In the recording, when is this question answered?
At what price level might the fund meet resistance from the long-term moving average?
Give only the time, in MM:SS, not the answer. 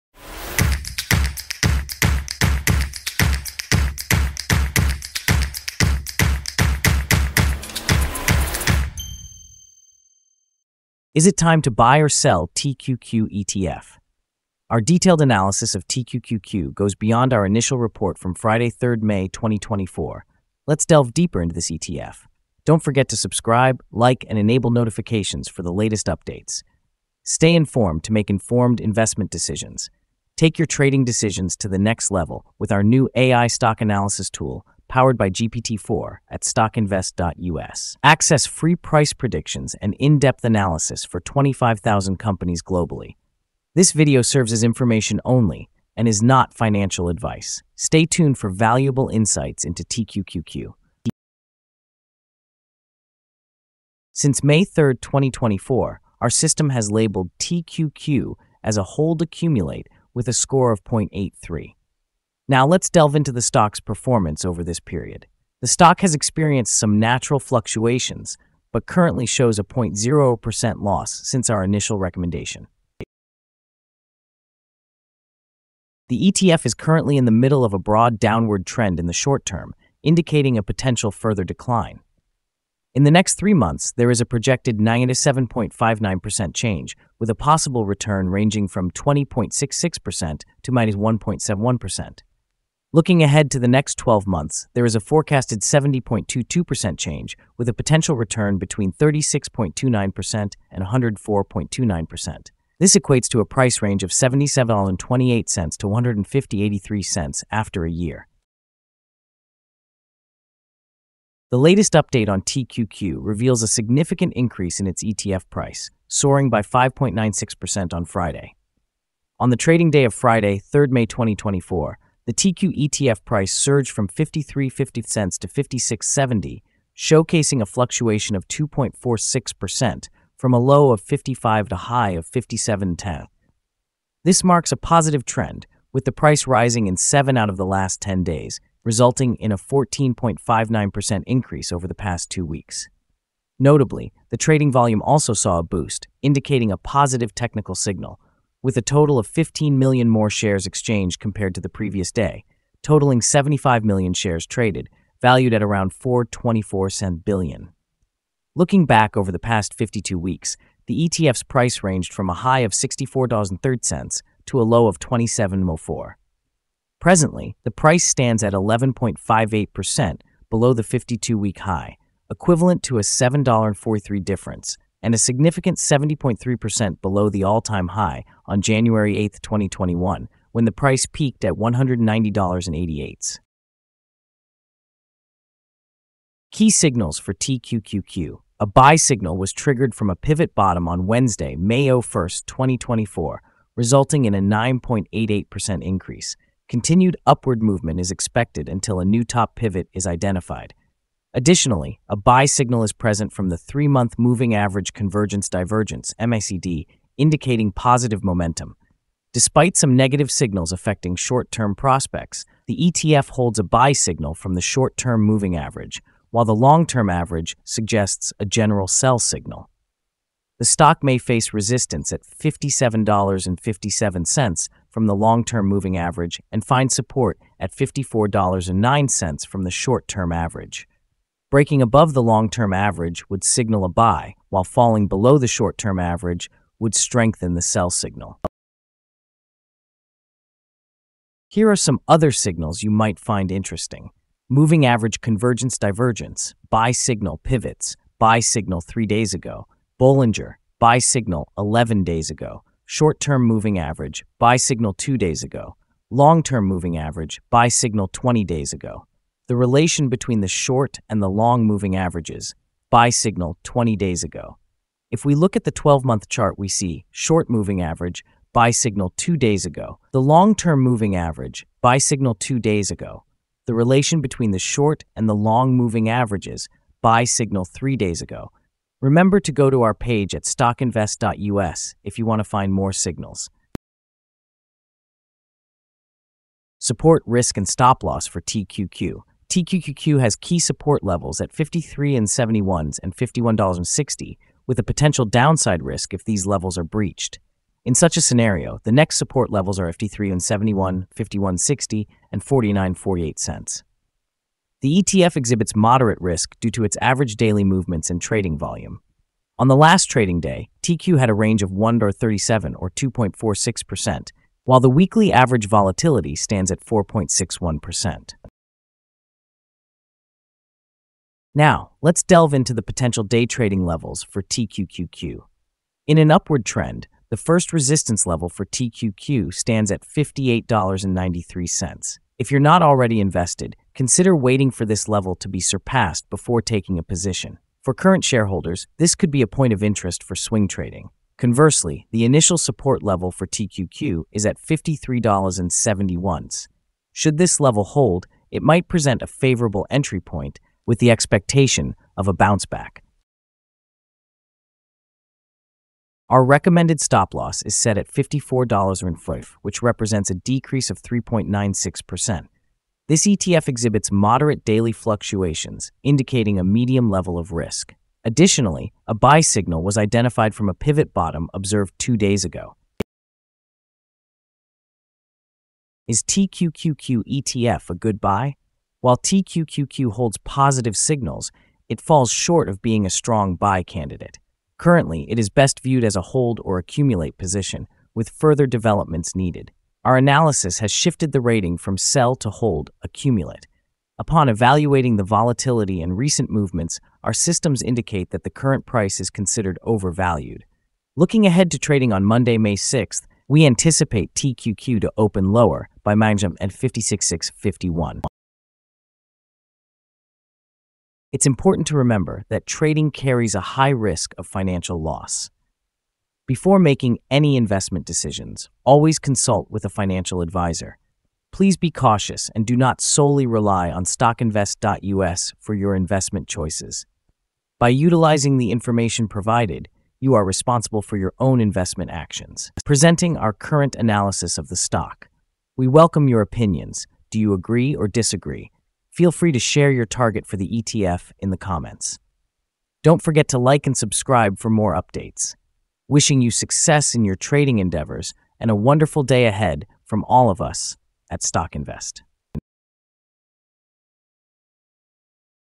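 03:42.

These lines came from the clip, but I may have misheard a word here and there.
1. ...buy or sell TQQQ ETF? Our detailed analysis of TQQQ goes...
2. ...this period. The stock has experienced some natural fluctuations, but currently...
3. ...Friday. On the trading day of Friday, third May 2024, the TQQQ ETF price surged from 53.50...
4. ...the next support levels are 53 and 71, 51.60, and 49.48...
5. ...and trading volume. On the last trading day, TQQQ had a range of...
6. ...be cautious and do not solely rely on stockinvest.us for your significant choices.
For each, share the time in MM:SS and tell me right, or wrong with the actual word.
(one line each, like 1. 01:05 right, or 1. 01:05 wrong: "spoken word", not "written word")
1. 00:11 right
2. 01:04 right
3. 01:58 right
4. 04:58 right
5. 05:08 right
6. 07:01 wrong: "investment", not "significant".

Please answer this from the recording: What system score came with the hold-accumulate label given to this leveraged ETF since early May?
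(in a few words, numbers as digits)
0.83.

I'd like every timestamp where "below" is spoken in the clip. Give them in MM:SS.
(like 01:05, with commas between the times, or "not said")
02:50, 02:57, 03:55.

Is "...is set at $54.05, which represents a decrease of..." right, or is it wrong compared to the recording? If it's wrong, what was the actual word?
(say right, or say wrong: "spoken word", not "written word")
right.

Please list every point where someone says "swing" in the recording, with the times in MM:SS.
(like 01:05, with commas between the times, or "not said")
05:40.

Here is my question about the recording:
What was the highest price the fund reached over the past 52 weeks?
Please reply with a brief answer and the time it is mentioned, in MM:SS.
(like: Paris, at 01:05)
$64.03, at 02:42.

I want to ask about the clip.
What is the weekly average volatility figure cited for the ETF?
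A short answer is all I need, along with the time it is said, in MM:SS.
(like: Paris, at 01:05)
4.61%, at 05:16.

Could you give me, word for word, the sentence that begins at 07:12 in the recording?
Presenting our current analysis of the stock.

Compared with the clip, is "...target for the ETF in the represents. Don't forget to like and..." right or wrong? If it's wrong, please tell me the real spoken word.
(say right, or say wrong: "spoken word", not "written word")
wrong: "comments", not "represents".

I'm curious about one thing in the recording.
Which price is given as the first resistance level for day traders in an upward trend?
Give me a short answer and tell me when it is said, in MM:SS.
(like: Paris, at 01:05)
$58.93, at 05:30.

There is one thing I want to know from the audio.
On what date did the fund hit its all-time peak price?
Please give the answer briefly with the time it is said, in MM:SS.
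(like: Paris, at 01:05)
January 8, 2021, at 02:58.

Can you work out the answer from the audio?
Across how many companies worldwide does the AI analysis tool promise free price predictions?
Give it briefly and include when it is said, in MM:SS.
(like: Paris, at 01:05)
25,000, at 00:41.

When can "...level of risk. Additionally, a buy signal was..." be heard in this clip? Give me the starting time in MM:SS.
06:07.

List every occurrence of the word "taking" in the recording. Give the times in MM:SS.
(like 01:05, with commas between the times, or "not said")
05:36.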